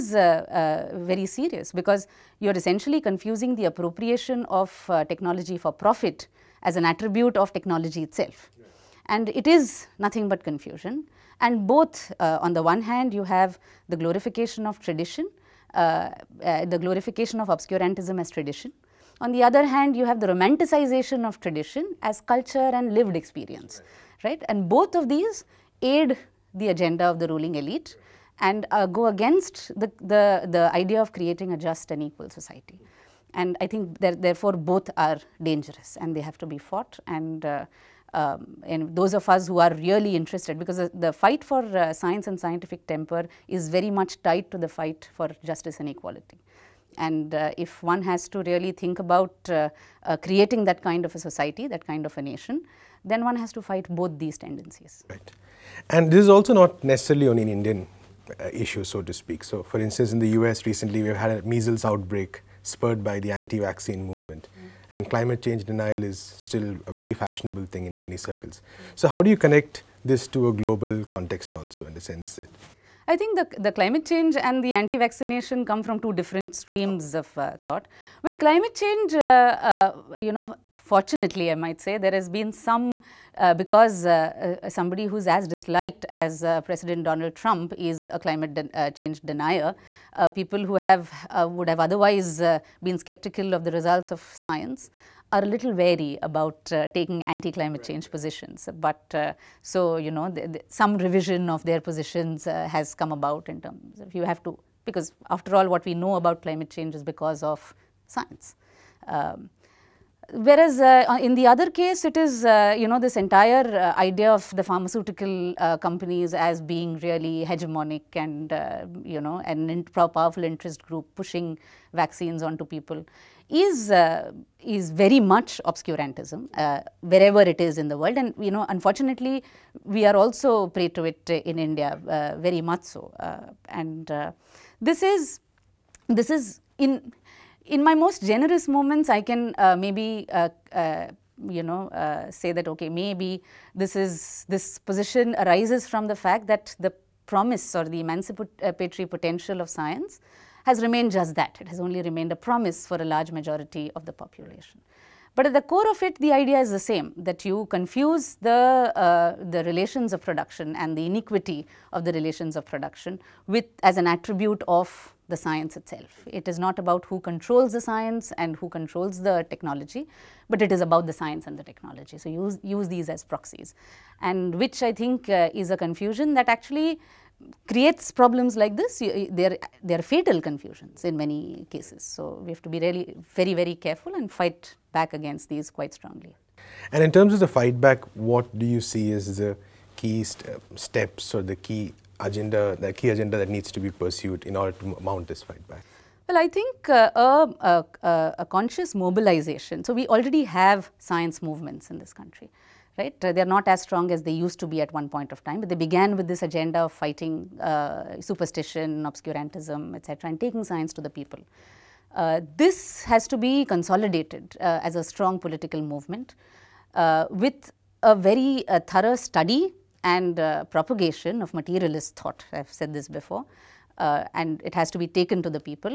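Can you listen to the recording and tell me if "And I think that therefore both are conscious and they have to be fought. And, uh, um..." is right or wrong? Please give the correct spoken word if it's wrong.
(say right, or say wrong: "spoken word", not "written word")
wrong: "dangerous", not "conscious".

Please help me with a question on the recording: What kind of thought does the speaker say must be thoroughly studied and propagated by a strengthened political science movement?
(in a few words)
materialist thought.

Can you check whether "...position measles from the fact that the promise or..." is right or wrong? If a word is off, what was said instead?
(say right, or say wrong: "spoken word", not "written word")
wrong: "arises", not "measles".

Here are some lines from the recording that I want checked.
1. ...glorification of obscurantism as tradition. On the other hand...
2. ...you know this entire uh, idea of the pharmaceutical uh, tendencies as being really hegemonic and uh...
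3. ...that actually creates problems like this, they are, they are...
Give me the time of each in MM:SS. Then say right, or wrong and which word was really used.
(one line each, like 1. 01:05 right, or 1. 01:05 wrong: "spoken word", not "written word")
1. 00:16 right
2. 01:52 wrong: "companies", not "tendencies"
3. 02:56 right.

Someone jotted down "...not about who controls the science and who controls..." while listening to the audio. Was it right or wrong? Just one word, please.
right.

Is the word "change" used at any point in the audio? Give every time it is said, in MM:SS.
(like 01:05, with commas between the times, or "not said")
01:05, 01:14, 01:18, 01:28, 01:37, 01:46.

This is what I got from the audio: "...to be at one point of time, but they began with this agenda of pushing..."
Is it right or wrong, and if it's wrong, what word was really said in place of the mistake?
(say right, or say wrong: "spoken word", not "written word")
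wrong: "fighting", not "pushing".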